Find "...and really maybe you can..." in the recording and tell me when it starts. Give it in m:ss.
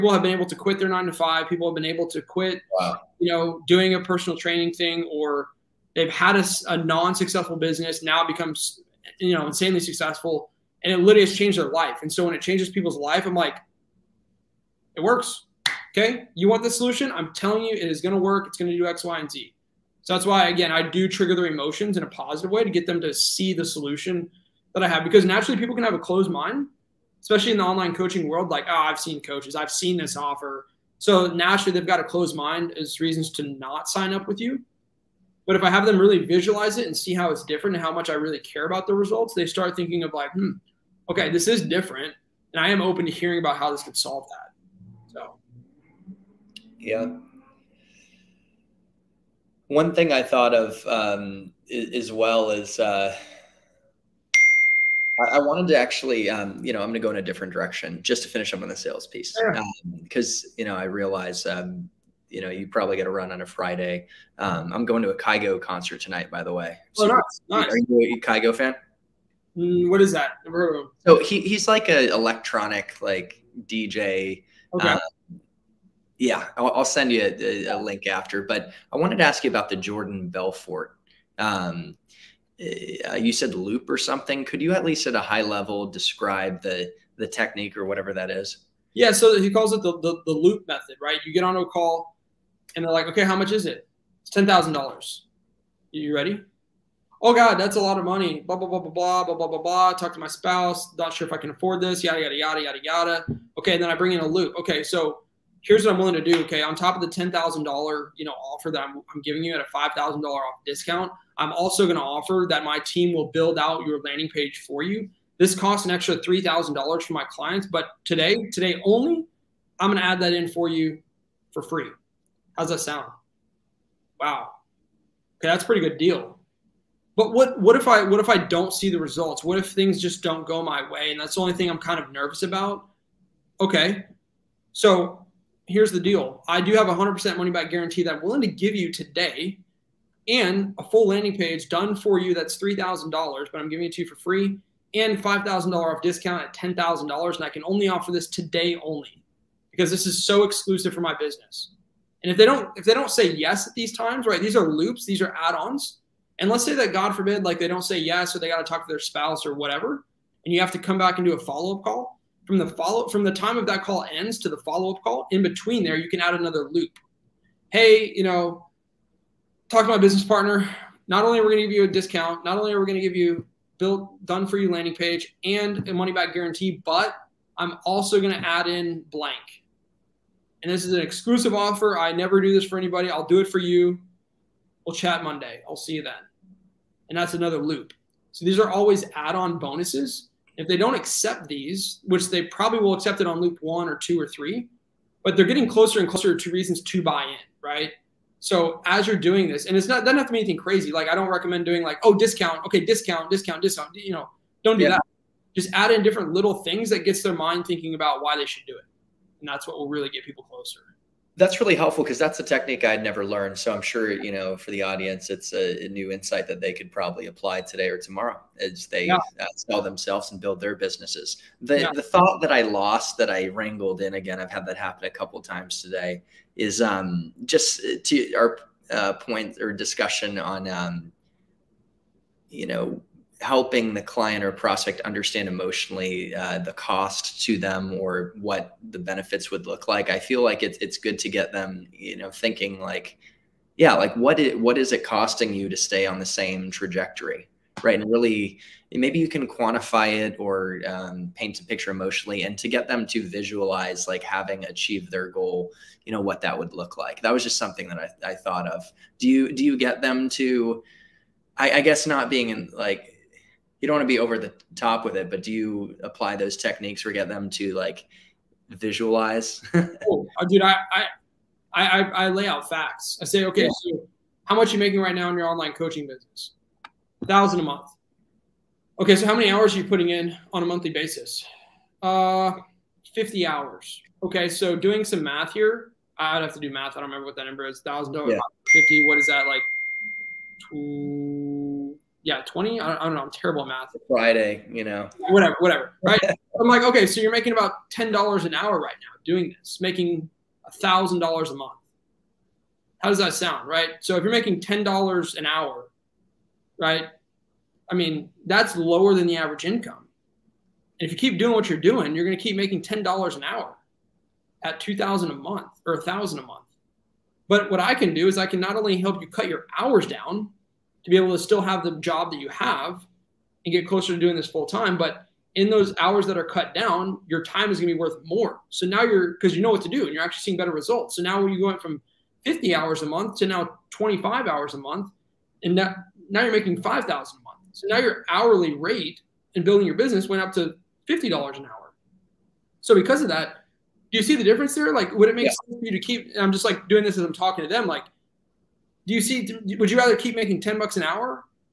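4:08.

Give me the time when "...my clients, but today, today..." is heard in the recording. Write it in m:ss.
1:57.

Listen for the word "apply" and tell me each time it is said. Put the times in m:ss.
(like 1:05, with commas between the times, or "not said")
3:37, 4:26.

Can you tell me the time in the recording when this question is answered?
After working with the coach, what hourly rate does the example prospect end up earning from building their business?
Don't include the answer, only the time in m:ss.
5:41.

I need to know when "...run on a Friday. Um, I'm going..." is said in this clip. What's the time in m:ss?
1:03.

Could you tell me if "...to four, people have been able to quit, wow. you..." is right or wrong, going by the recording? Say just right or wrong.
wrong.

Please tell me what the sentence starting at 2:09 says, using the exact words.
What if things just don't go my way?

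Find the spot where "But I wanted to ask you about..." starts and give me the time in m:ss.
1:18.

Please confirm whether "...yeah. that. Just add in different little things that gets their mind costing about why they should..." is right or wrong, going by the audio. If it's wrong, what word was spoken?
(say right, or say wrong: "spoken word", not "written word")
wrong: "thinking", not "costing".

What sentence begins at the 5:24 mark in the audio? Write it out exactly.
But in those hours that are cut down, your time is going to be worth more.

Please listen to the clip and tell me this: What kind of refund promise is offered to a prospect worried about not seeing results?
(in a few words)
100% money back guarantee.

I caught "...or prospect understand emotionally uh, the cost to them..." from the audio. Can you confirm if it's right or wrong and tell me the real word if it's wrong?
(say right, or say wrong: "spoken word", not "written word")
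right.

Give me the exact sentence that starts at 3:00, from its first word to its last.
And this is an exclusive offer.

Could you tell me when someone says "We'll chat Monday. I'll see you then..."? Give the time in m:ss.
3:04.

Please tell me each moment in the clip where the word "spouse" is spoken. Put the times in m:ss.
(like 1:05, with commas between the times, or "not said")
1:40, 2:38.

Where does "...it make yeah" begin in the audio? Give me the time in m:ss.
5:45.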